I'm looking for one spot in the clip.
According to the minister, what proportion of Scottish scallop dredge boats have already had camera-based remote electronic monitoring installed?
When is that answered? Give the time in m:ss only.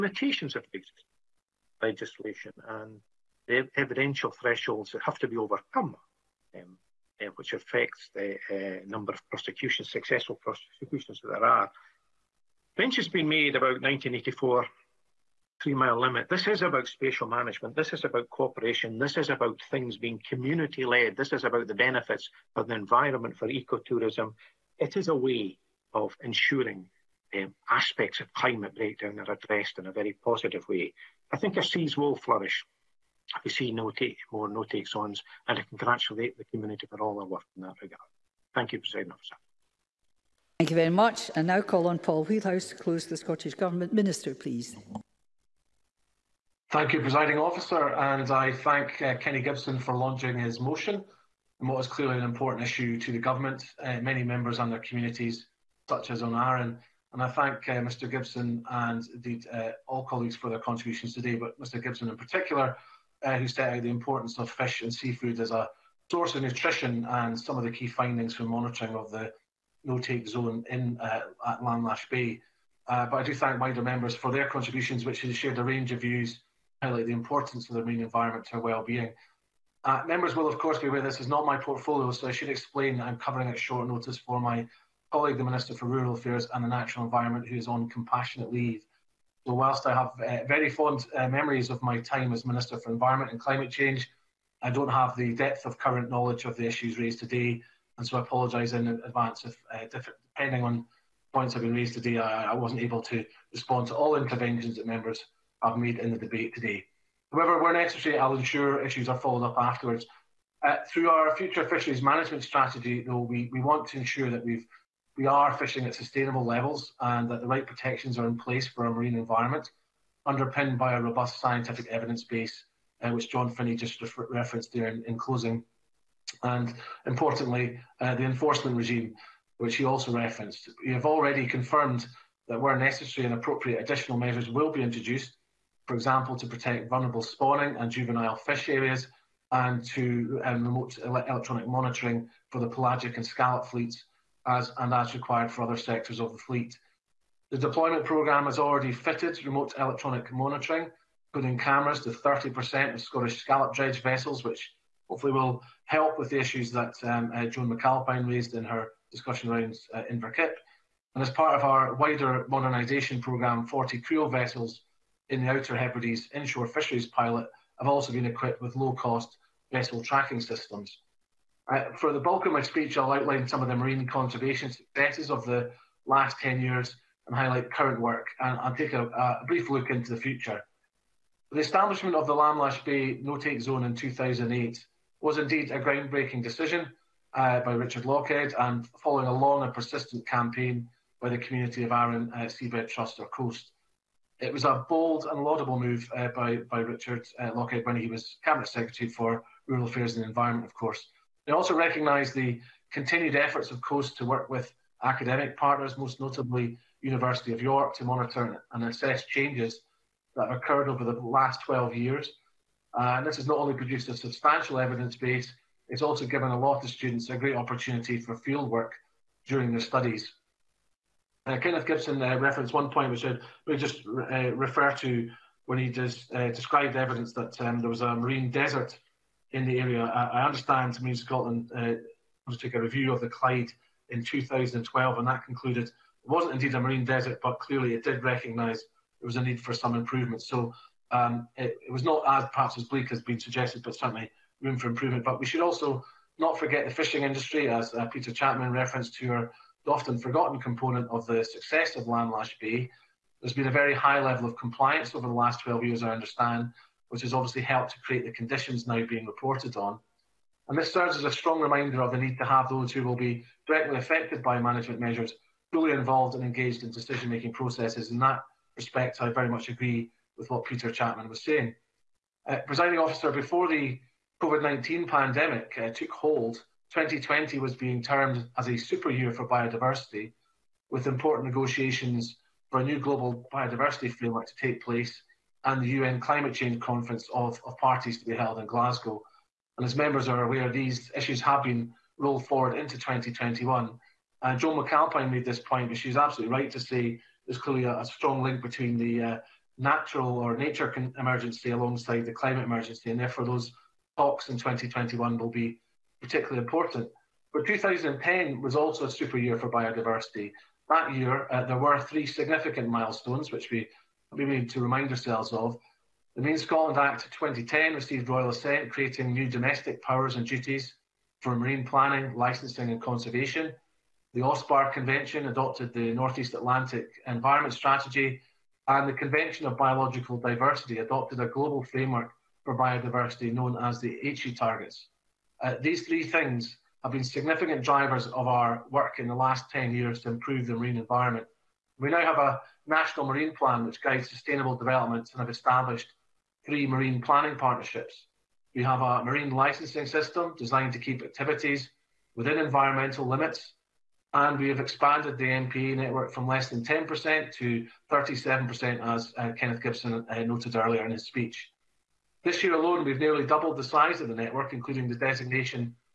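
2:32.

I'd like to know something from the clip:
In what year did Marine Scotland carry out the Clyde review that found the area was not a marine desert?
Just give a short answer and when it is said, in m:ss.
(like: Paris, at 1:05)
2012, at 3:54.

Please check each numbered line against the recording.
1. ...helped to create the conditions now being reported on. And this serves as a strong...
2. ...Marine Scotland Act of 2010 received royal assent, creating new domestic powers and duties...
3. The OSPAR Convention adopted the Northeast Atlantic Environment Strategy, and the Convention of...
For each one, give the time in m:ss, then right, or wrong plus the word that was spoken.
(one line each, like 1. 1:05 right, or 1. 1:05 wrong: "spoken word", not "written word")
1. 4:17 right
2. 5:16 right
3. 5:24 right.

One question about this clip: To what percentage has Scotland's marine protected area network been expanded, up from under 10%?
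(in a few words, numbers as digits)
37%.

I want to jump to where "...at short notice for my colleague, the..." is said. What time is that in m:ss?
1:23.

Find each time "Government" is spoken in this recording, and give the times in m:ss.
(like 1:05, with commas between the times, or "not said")
0:43, 0:53.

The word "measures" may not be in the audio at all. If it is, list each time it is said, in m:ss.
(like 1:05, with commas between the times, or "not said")
2:14, 4:24.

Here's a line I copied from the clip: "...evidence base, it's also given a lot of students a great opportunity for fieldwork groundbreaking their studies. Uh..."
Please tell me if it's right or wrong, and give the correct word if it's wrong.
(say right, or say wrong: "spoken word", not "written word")
wrong: "during", not "groundbreaking".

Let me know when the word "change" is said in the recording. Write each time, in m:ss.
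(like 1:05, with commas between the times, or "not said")
1:33, 3:29, 4:46.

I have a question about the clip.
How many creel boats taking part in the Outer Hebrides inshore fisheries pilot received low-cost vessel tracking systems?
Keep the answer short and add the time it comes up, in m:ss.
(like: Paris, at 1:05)
40, at 2:43.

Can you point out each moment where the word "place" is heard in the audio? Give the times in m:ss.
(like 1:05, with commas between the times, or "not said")
1:58, 4:44.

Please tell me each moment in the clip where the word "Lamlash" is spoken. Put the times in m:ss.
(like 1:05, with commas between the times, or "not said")
1:11, 3:02.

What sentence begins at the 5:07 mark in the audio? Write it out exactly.
But 2010 was also a super year for biodiversity.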